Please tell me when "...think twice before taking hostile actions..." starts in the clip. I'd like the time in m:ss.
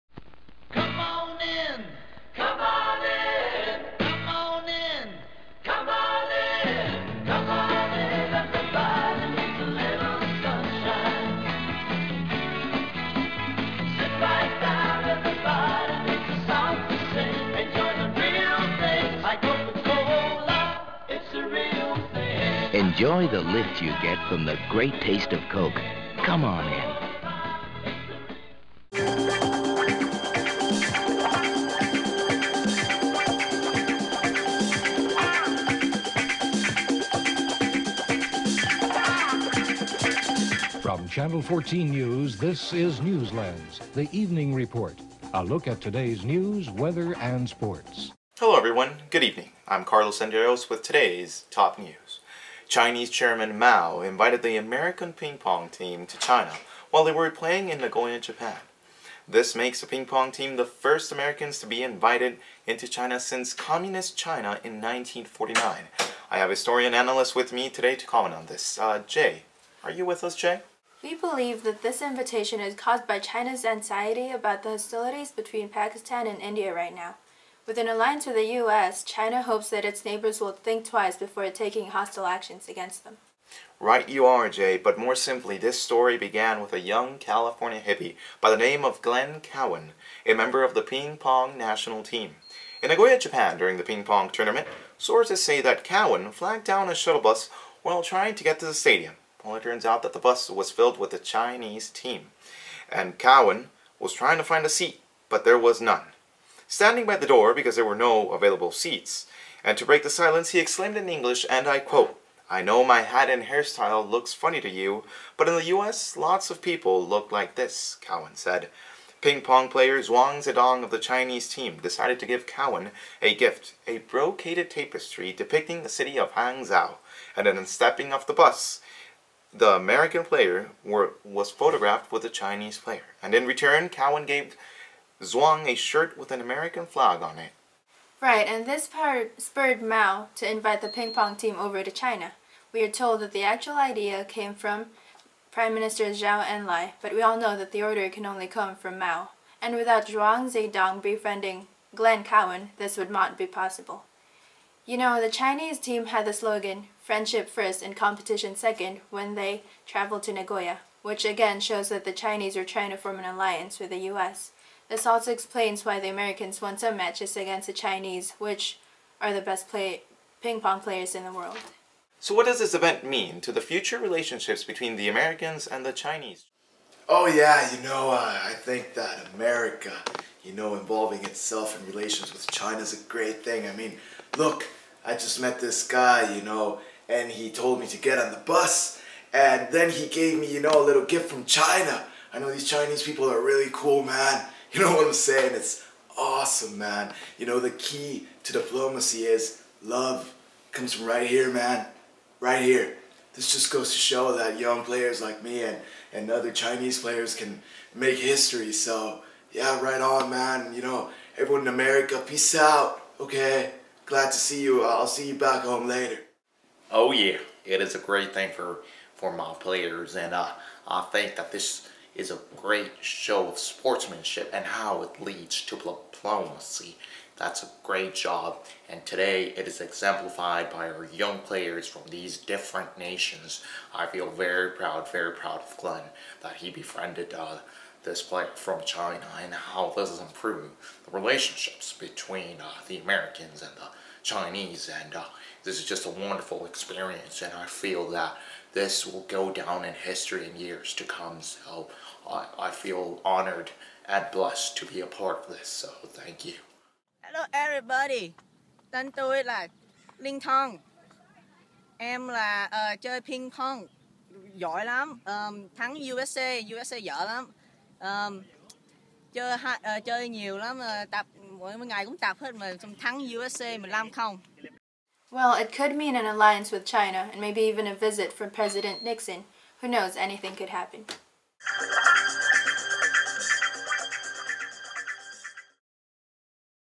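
1:20.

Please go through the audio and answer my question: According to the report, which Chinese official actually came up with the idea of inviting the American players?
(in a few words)
Zhou Enlai.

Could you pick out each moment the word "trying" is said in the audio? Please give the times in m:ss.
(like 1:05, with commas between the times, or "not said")
1:38, 1:44, 2:42.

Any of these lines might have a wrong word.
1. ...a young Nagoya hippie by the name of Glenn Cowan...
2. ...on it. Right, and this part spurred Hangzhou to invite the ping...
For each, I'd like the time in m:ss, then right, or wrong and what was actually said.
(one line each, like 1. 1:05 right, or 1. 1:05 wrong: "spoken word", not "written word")
1. 1:26 wrong: "California", not "Nagoya"
2. 2:17 wrong: "Mao", not "Hangzhou".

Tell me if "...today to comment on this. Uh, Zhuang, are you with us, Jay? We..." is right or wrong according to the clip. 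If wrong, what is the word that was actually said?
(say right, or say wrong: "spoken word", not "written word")
wrong: "Jay", not "Zhuang".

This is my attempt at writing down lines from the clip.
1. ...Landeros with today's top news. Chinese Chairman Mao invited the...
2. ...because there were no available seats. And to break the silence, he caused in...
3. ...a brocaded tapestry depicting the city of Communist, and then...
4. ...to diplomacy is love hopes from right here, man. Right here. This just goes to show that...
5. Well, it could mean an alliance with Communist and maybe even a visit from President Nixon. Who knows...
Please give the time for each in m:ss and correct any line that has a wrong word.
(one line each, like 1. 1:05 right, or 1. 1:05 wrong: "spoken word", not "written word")
1. 0:50 right
2. 1:47 wrong: "exclaimed", not "caused"
3. 2:03 wrong: "Hangzhou", not "Communist"
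4. 3:18 wrong: "comes", not "hopes"
5. 4:35 wrong: "China", not "Communist".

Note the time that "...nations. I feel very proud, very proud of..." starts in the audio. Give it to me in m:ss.
3:52.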